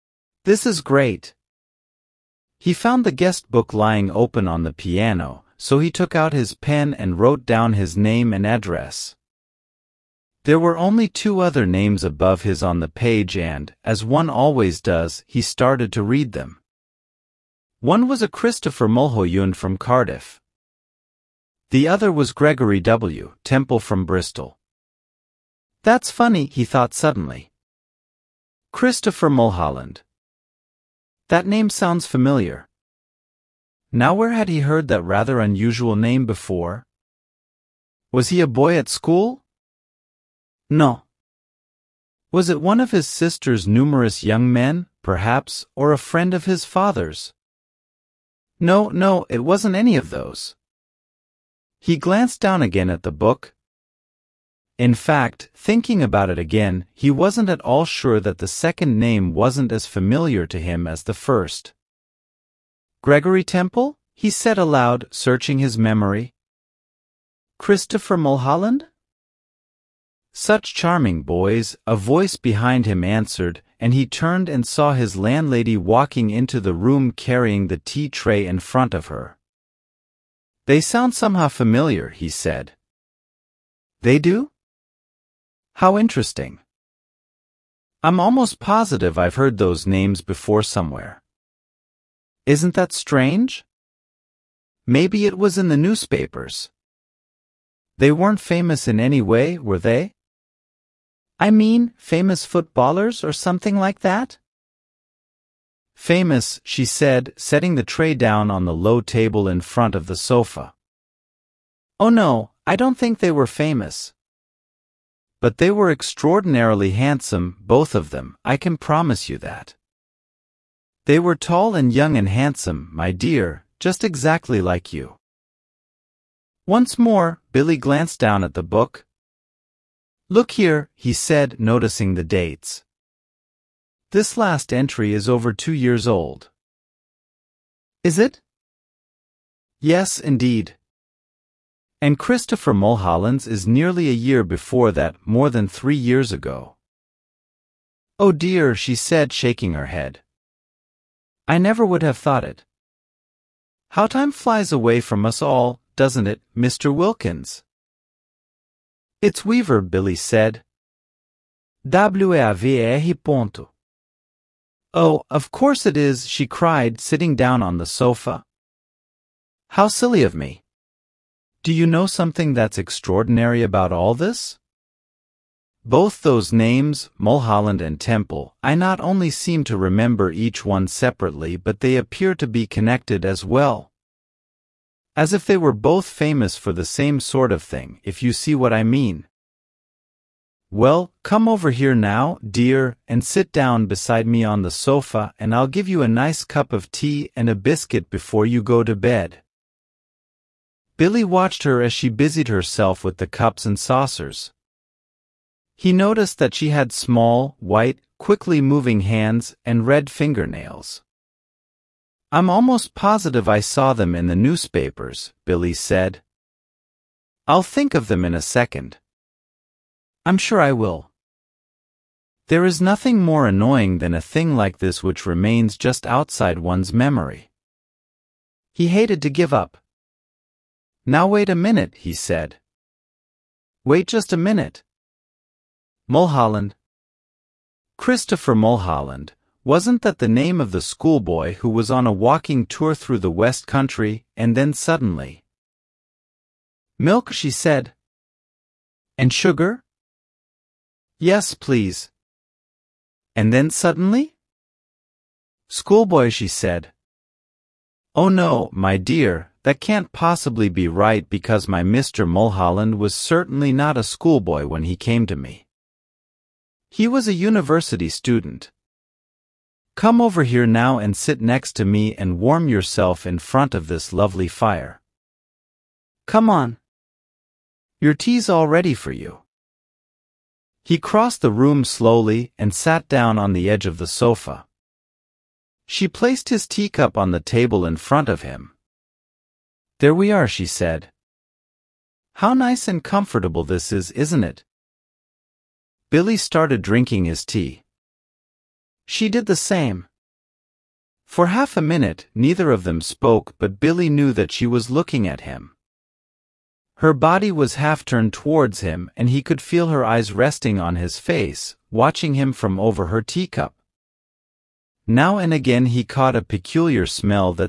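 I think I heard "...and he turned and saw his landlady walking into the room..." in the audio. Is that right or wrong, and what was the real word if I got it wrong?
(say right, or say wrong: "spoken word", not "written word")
right.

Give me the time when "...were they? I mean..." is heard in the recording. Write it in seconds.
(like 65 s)
99 s.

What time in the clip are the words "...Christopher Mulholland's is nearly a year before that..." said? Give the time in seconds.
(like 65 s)
142 s.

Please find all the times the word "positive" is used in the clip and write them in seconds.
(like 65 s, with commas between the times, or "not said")
88 s, 212 s.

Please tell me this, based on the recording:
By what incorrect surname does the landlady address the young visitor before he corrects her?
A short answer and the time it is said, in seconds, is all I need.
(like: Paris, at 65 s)
Wilkins, at 156 s.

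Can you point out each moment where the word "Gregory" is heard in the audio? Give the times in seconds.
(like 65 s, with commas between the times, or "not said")
22 s, 63 s.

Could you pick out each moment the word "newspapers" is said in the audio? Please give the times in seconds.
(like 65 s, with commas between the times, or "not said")
95 s, 214 s.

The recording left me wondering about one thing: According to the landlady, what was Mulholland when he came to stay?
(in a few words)
University student.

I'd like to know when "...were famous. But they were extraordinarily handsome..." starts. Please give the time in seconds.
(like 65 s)
113 s.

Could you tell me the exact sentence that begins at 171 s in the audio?
Do you know something that's extraordinary about all this?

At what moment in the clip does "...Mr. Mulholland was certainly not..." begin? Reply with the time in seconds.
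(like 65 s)
261 s.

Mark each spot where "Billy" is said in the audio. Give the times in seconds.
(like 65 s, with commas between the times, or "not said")
127 s, 159 s, 201 s, 215 s, 296 s, 303 s.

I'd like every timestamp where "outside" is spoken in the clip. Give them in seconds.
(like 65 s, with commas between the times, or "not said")
226 s.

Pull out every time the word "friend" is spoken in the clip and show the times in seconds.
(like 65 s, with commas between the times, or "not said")
45 s.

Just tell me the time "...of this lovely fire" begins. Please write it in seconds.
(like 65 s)
273 s.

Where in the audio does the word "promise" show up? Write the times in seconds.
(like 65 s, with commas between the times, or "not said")
118 s.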